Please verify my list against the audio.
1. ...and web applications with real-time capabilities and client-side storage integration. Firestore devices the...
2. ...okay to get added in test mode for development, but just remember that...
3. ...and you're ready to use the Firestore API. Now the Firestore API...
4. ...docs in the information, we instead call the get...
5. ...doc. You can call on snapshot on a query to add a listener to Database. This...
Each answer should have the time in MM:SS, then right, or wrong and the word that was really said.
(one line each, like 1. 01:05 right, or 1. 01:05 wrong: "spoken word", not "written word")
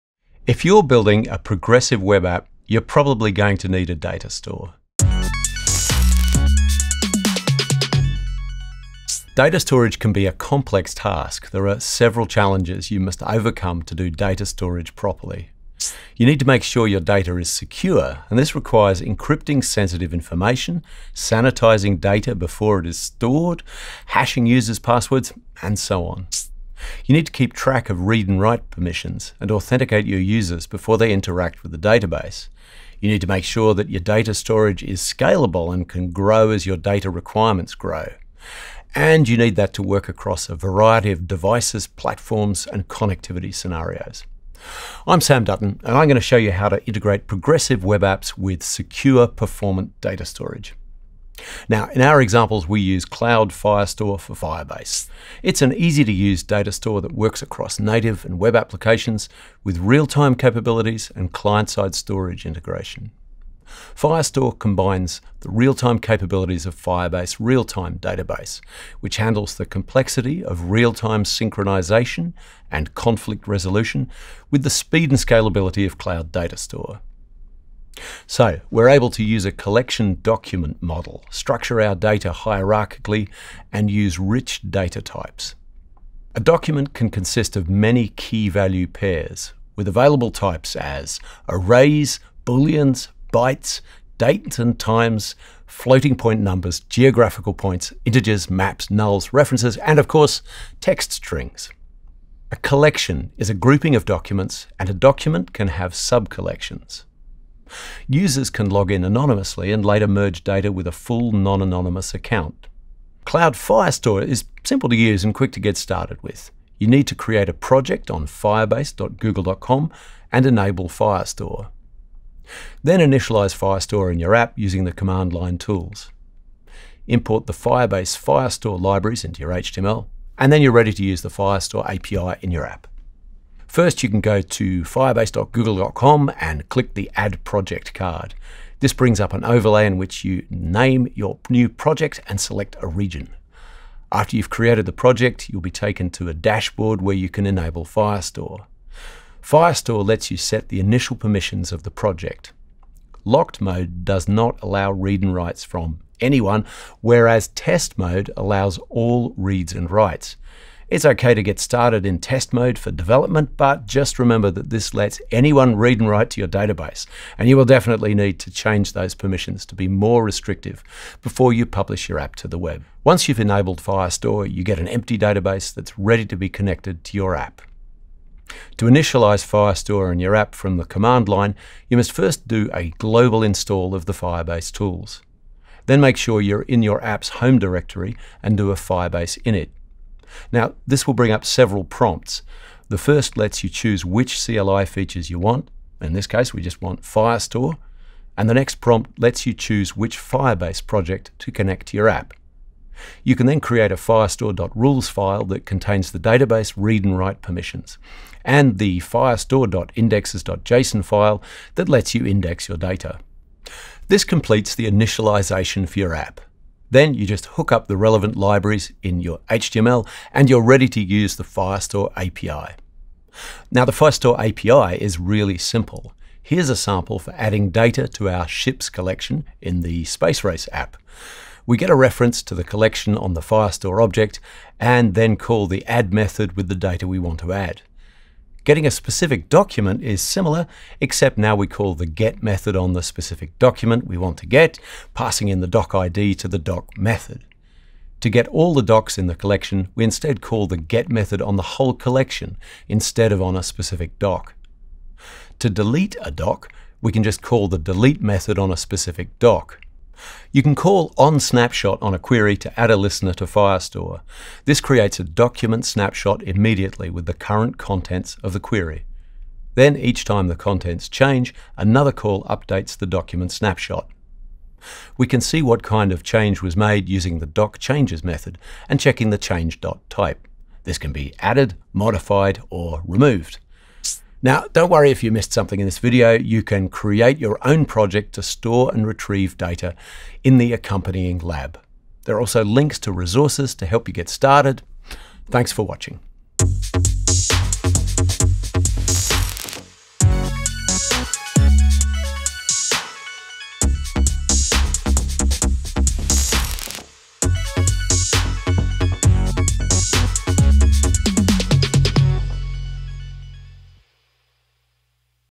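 1. 00:58 wrong: "combines", not "devices"
2. 02:41 wrong: "started", not "added"
3. 03:40 right
4. 04:08 wrong: "collection", not "information"
5. 04:19 wrong: "Firestore", not "Database".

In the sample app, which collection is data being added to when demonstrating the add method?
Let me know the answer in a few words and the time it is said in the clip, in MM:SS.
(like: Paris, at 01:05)
ships, at 03:48.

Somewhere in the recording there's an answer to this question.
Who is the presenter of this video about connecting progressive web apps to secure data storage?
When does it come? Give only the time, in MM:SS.
00:45.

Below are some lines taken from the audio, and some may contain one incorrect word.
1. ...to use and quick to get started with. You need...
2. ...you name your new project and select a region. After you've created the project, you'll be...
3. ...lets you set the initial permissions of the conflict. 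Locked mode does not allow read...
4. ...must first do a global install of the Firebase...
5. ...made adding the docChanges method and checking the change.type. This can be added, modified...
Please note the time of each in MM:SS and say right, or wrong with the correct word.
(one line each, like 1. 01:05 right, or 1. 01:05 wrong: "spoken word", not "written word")
1. 01:54 right
2. 02:20 right
3. 02:30 wrong: "project", not "conflict"
4. 03:01 right
5. 04:36 wrong: "using", not "adding".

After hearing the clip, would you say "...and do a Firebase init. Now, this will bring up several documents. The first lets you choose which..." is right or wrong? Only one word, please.
wrong.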